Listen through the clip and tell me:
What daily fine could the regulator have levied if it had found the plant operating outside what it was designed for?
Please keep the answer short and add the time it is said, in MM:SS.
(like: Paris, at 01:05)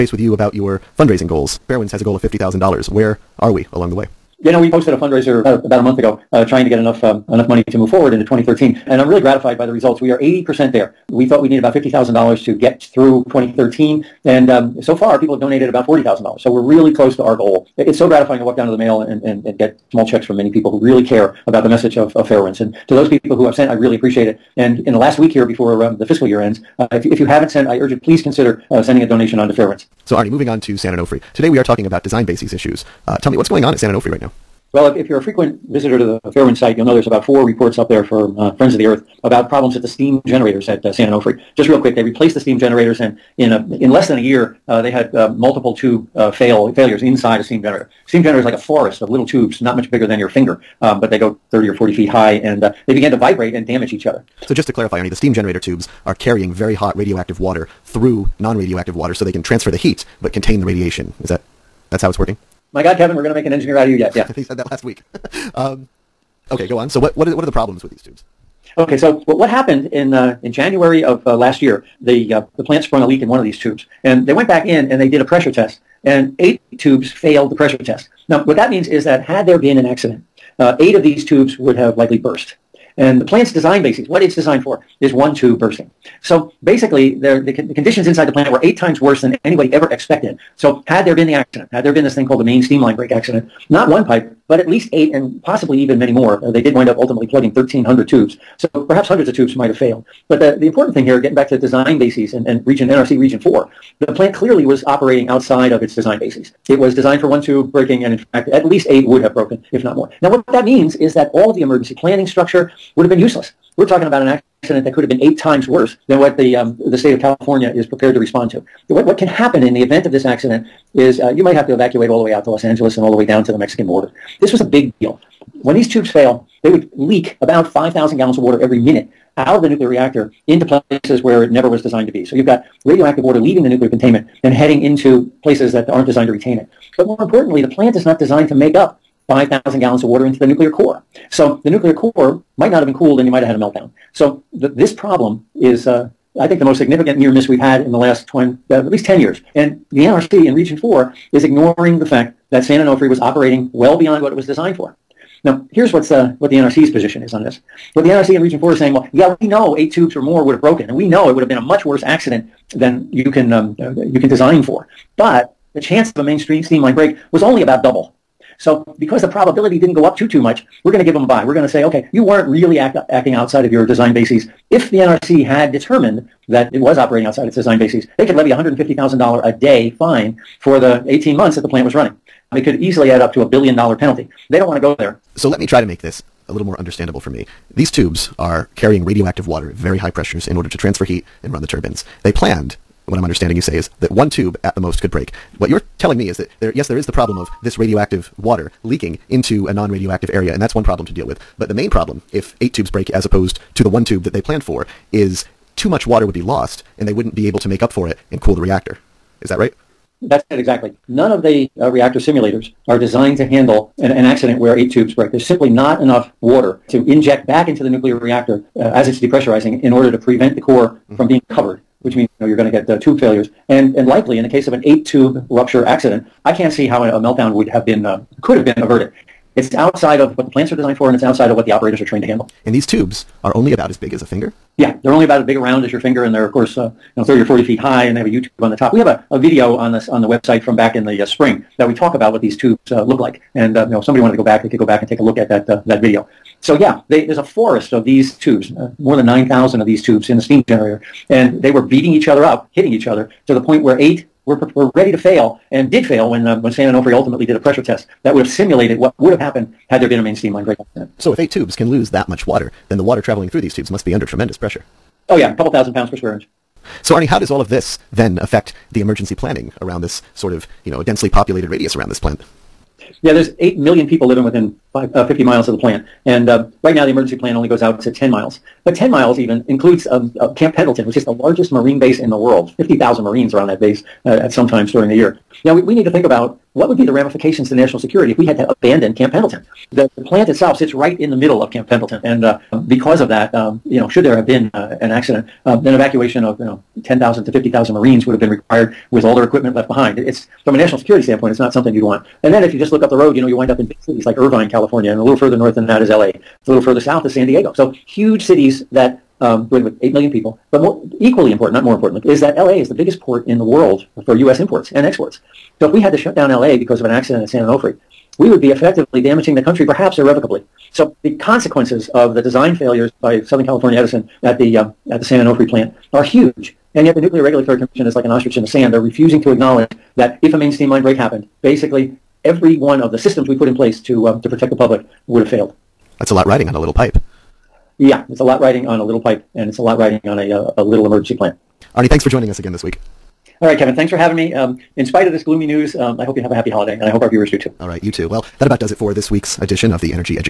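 $150,000, at 02:58.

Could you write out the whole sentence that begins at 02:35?
Now, here's what's, uh, what the NRC's position is on this.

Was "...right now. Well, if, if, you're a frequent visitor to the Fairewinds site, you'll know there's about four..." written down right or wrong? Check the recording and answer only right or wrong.
right.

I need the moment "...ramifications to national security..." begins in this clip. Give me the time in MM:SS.
04:47.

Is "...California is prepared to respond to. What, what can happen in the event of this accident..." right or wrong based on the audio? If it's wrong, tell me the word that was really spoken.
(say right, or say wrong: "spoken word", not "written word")
right.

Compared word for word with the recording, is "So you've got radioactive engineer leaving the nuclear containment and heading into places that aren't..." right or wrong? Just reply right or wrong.
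wrong.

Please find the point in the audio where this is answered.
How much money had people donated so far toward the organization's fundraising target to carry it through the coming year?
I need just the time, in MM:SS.
00:15.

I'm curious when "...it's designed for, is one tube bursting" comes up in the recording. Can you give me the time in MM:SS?
01:24.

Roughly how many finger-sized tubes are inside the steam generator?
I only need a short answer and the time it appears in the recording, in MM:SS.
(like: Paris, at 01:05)
more than 9,000, at 04:08.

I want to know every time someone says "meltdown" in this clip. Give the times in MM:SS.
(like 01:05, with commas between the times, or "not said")
02:23, 03:47.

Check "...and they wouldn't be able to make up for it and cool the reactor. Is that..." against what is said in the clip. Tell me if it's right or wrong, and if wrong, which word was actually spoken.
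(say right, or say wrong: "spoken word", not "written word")
right.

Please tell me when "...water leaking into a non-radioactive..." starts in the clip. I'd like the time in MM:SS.
03:18.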